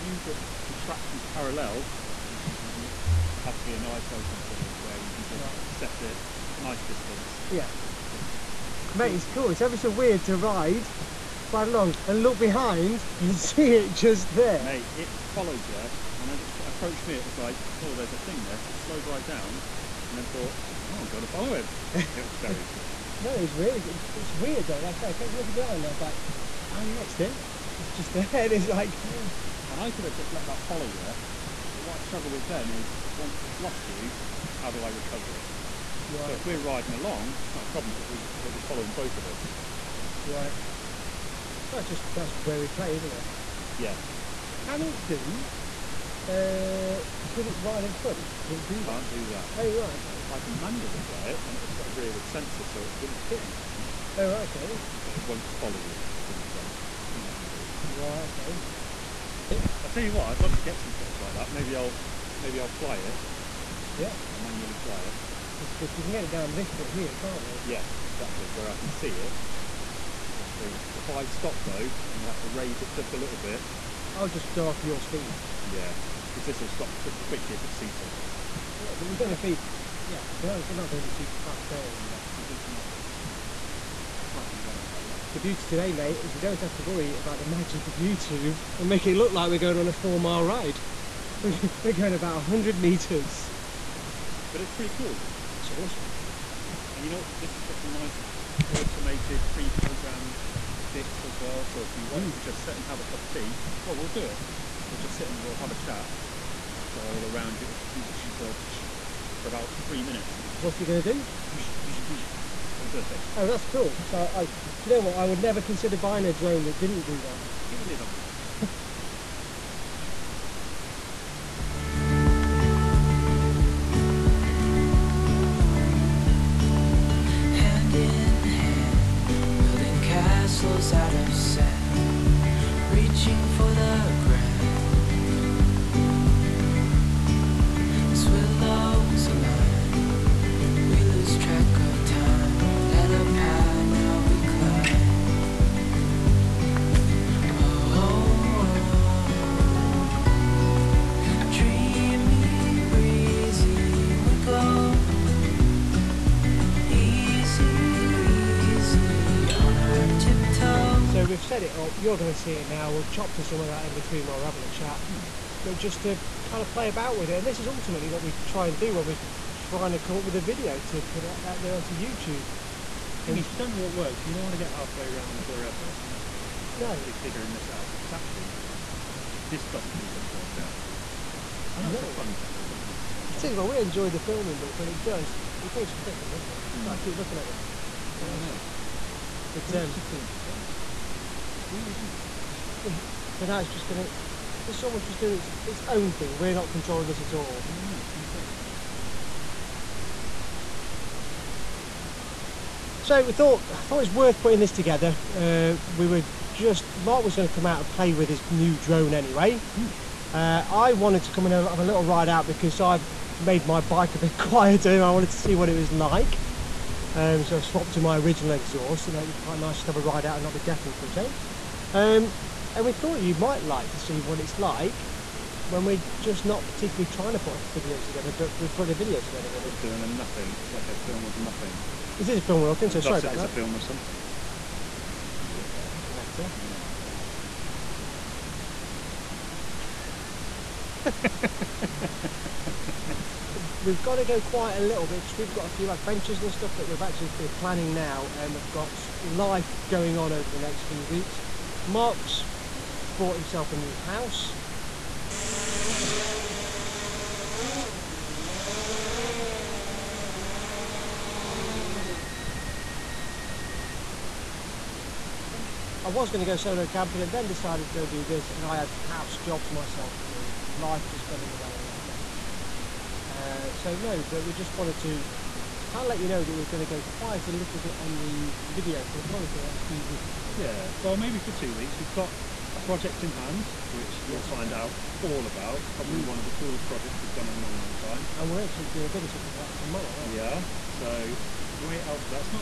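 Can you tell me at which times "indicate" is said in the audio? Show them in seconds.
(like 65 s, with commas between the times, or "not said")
not said.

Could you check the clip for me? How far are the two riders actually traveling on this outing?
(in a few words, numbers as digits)
100 metres.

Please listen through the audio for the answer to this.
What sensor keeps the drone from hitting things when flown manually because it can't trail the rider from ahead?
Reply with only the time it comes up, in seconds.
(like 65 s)
51 s.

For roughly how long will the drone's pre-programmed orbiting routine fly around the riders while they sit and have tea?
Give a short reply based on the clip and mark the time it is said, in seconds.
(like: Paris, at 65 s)
3 minutes, at 109 s.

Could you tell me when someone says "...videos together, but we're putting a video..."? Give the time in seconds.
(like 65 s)
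227 s.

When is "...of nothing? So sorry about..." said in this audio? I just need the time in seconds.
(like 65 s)
232 s.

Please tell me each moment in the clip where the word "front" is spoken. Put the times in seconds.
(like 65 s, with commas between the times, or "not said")
47 s, 56 s.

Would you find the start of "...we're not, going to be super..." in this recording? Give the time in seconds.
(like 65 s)
80 s.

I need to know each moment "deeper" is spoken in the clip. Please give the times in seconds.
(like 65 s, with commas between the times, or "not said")
not said.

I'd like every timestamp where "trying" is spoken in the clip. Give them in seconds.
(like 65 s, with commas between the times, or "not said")
169 s, 227 s.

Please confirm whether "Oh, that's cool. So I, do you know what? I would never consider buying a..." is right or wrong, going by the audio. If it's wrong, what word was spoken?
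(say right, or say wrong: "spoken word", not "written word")
right.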